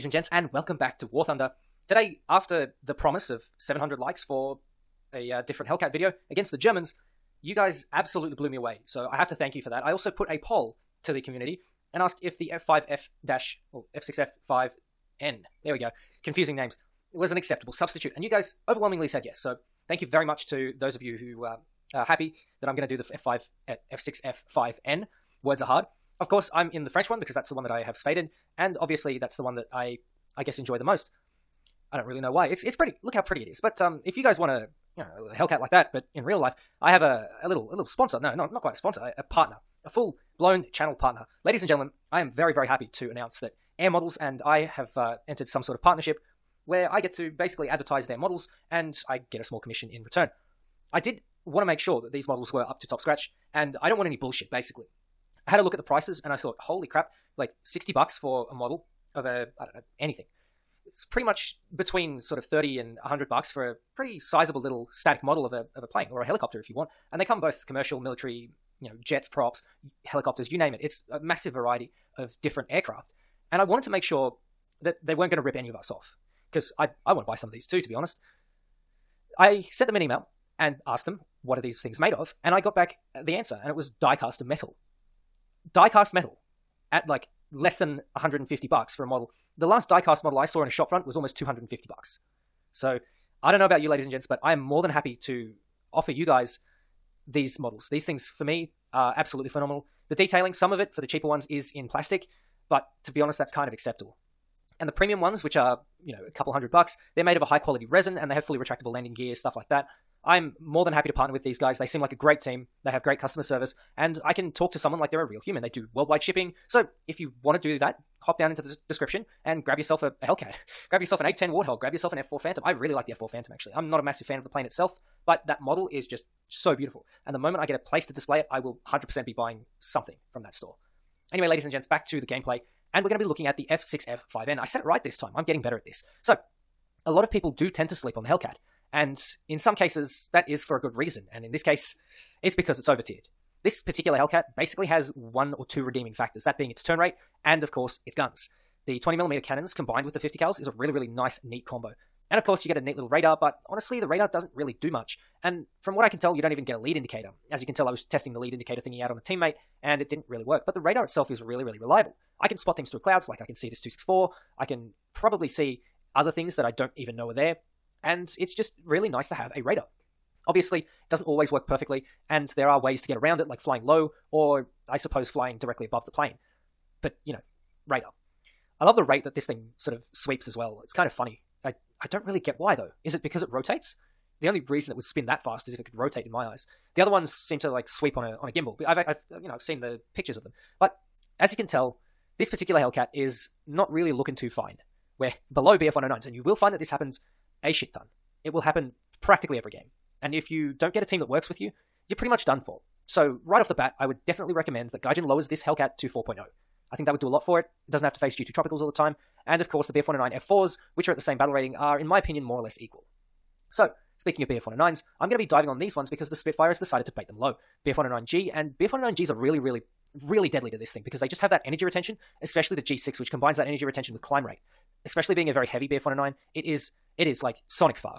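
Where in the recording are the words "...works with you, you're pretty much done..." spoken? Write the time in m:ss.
3:21.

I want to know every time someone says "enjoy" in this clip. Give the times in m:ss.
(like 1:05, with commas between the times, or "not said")
0:30.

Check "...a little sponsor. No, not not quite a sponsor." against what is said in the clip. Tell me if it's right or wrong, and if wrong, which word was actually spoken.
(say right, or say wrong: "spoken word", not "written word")
right.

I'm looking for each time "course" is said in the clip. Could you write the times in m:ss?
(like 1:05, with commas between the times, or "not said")
0:26, 2:27, 2:32, 3:29.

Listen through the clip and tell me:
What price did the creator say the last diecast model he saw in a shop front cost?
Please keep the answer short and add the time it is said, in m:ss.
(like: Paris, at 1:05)
250 bucks, at 1:31.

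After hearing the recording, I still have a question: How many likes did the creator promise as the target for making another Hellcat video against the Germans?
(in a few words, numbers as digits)
700.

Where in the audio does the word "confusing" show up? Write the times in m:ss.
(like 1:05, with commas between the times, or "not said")
0:16.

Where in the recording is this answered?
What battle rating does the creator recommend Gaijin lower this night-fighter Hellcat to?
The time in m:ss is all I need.
3:26.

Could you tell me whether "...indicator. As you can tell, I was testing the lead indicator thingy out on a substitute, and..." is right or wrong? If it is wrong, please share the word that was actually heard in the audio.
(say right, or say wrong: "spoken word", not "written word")
wrong: "teammate", not "substitute".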